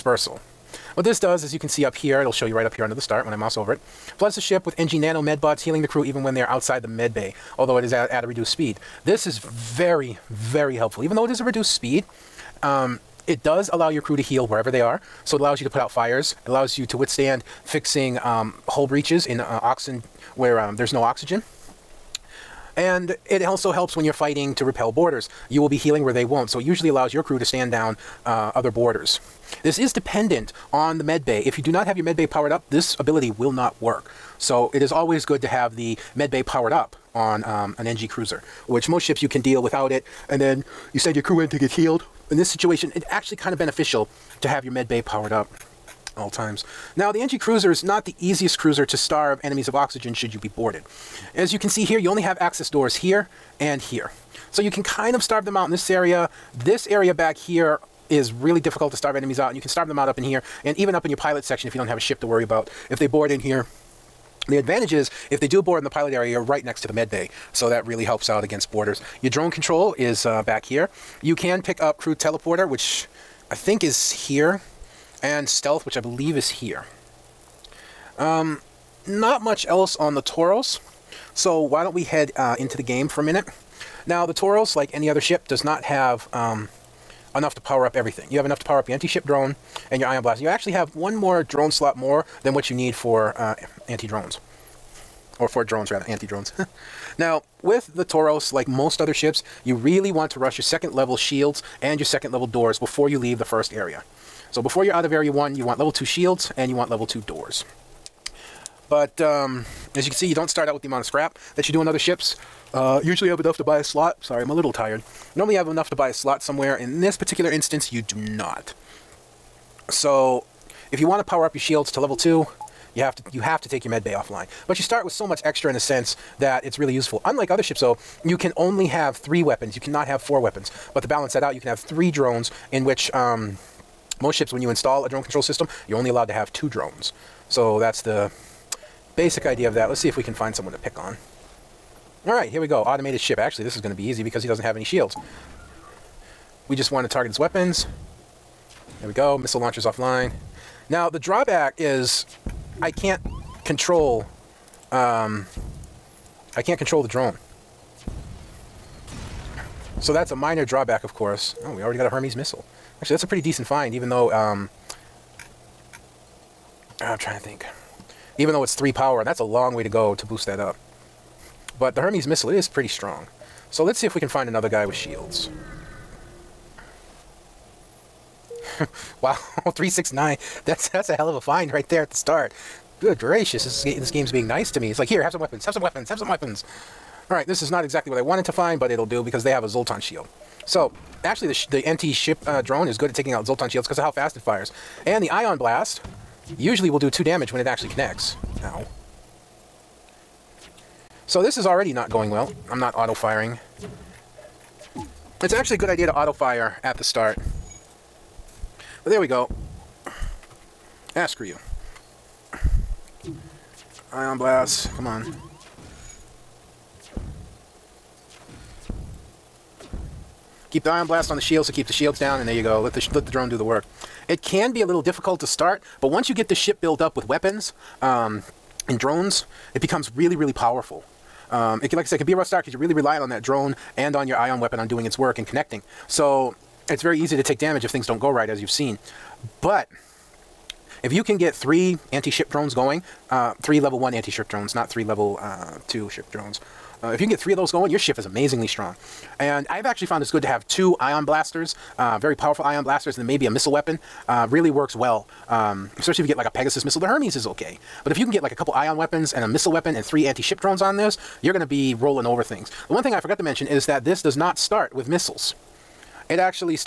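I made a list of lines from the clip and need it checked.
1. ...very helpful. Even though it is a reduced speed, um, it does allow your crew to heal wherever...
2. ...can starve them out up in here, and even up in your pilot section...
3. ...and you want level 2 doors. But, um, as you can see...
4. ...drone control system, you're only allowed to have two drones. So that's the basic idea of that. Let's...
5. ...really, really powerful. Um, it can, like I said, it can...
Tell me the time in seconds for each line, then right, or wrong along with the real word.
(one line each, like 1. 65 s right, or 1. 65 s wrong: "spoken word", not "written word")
1. 10 s right
2. 59 s right
3. 106 s right
4. 135 s right
5. 230 s right.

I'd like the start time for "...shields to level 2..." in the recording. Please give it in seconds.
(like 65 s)
121 s.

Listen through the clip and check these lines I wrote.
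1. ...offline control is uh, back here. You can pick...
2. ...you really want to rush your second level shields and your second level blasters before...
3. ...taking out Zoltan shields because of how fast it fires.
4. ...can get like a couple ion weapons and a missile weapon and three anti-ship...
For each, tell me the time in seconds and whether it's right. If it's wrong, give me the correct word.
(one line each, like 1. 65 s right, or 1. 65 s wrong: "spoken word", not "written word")
1. 69 s wrong: "drone", not "offline"
2. 99 s wrong: "doors", not "blasters"
3. 193 s right
4. 258 s right.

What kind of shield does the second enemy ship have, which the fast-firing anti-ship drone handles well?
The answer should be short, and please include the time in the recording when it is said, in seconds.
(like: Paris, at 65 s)
Zoltan shield, at 189 s.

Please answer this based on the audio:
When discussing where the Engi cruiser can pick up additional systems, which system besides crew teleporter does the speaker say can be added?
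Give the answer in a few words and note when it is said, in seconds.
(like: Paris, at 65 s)
Stealth, at 75 s.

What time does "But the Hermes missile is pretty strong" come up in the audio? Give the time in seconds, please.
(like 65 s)
171 s.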